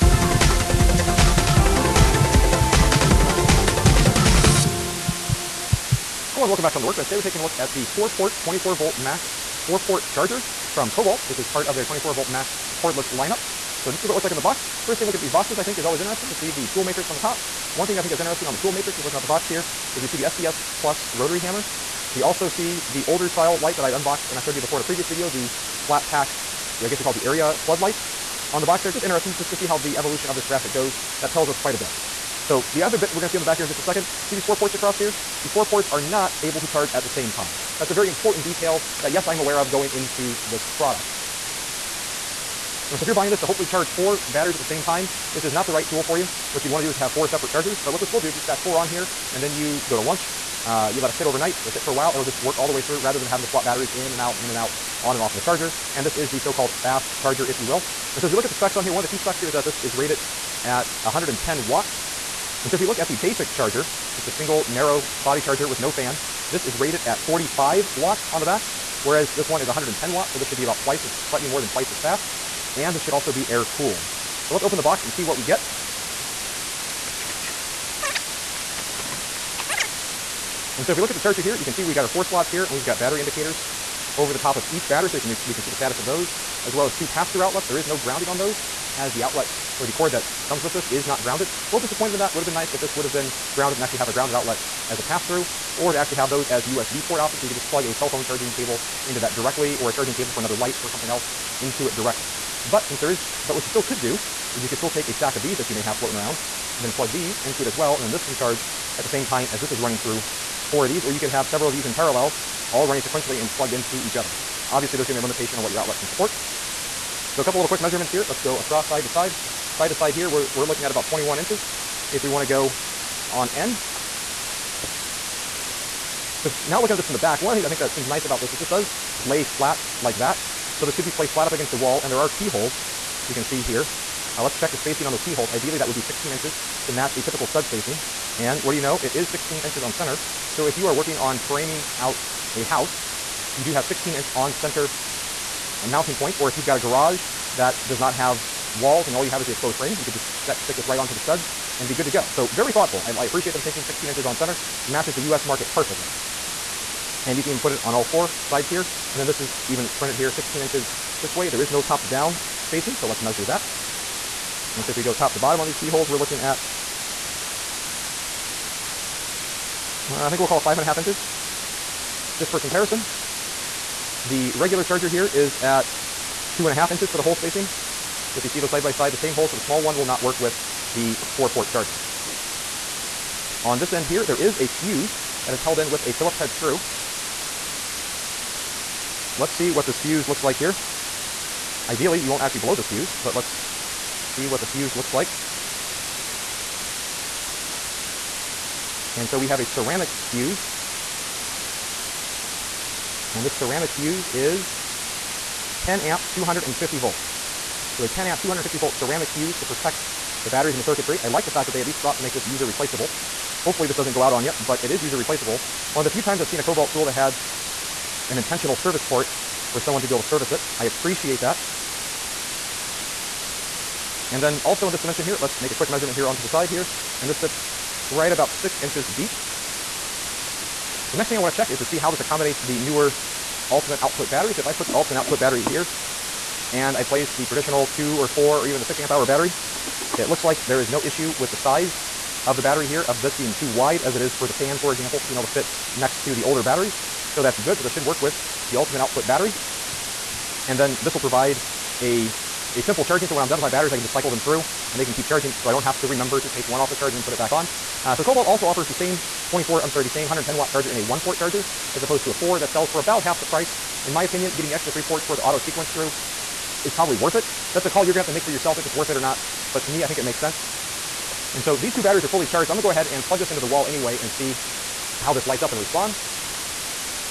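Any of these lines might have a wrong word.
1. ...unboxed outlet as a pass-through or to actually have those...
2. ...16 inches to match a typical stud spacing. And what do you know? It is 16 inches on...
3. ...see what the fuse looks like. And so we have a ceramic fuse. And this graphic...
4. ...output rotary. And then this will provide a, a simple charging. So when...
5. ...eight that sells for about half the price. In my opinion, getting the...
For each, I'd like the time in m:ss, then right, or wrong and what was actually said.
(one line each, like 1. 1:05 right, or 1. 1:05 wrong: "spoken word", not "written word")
1. 1:34 wrong: "grounded", not "unboxed"
2. 2:16 right
3. 3:14 wrong: "ceramic", not "graphic"
4. 4:08 wrong: "battery", not "rotary"
5. 4:22 wrong: "four", not "eight".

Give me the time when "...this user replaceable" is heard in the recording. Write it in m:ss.
3:32.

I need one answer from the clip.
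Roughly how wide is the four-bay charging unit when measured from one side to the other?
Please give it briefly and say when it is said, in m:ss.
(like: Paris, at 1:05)
21 inches, at 2:01.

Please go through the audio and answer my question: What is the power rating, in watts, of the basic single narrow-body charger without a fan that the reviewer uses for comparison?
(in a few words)
45 watts.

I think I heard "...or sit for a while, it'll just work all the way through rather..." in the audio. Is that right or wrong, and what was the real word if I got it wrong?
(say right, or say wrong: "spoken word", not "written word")
right.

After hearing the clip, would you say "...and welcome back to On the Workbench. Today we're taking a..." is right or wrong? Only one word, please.
right.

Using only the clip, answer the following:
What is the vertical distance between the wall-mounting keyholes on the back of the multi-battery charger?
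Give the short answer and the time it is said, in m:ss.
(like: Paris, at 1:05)
5.5 inches, at 2:50.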